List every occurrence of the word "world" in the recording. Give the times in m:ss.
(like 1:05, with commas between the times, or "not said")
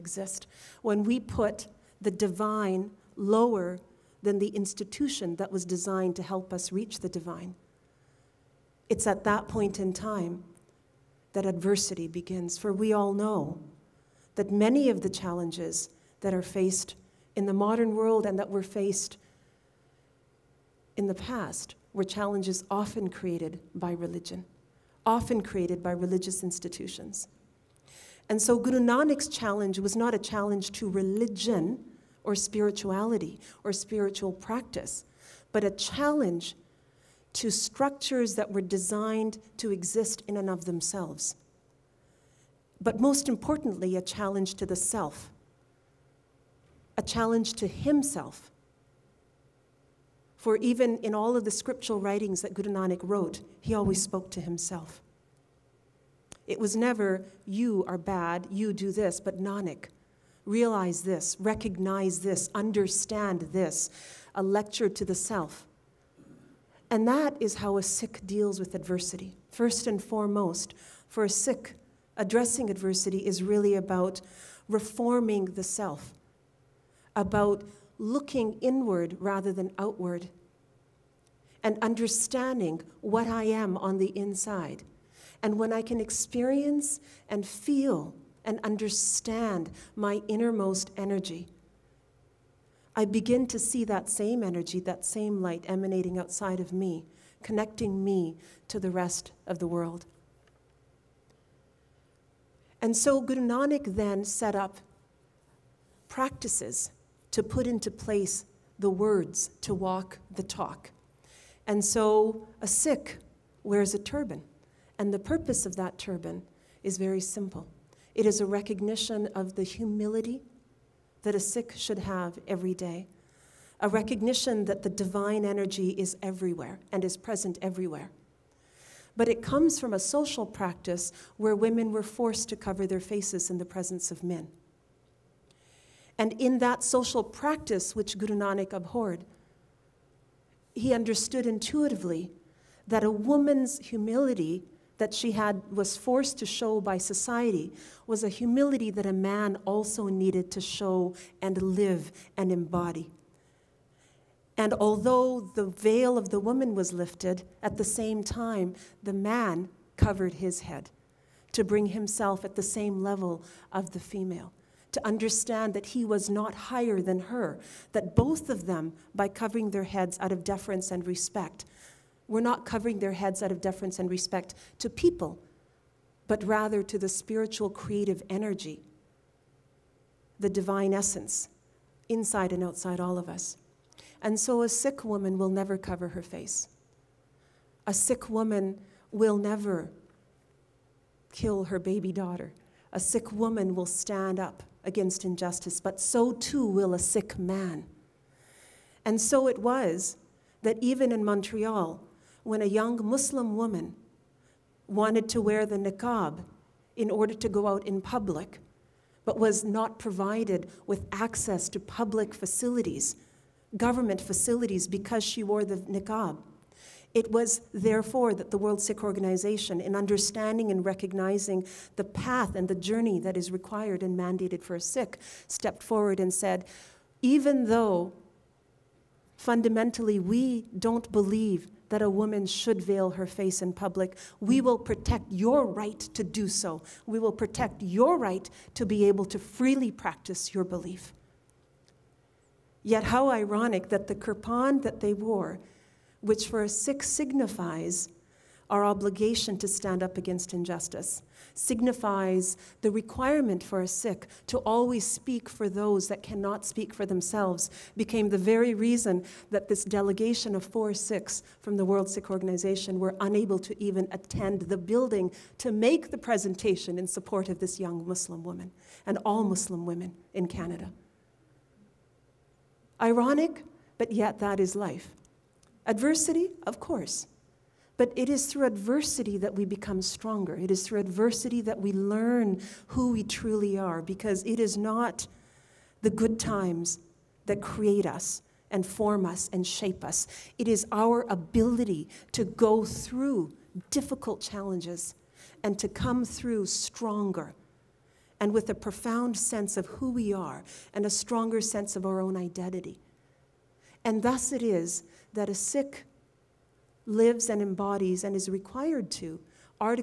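0:17, 1:39, 3:38, 4:21.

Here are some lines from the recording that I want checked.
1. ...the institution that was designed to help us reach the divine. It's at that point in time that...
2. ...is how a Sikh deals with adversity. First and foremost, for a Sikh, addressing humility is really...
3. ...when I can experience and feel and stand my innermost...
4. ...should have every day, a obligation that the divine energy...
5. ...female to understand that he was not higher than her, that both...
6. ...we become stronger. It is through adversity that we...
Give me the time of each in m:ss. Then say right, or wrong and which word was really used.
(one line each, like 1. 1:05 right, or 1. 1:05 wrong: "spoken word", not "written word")
1. 0:04 right
2. 1:07 wrong: "adversity", not "humility"
3. 1:25 wrong: "understand", not "stand"
4. 2:01 wrong: "recognition", not "obligation"
5. 2:43 right
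6. 4:39 right.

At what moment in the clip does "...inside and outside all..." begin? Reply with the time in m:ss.
3:02.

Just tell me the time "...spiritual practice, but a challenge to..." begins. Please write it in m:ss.
0:33.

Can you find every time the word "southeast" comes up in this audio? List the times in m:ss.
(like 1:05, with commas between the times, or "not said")
not said.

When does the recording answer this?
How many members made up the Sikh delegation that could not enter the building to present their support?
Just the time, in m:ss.
4:20.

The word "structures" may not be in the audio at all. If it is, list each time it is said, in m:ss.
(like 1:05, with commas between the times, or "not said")
0:37.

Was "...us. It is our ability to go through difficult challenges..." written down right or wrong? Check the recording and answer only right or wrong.
right.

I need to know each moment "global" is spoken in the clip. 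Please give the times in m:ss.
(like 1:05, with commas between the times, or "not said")
not said.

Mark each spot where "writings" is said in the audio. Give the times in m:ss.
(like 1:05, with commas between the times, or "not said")
0:51.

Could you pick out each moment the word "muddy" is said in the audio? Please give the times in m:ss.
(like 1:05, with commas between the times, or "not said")
not said.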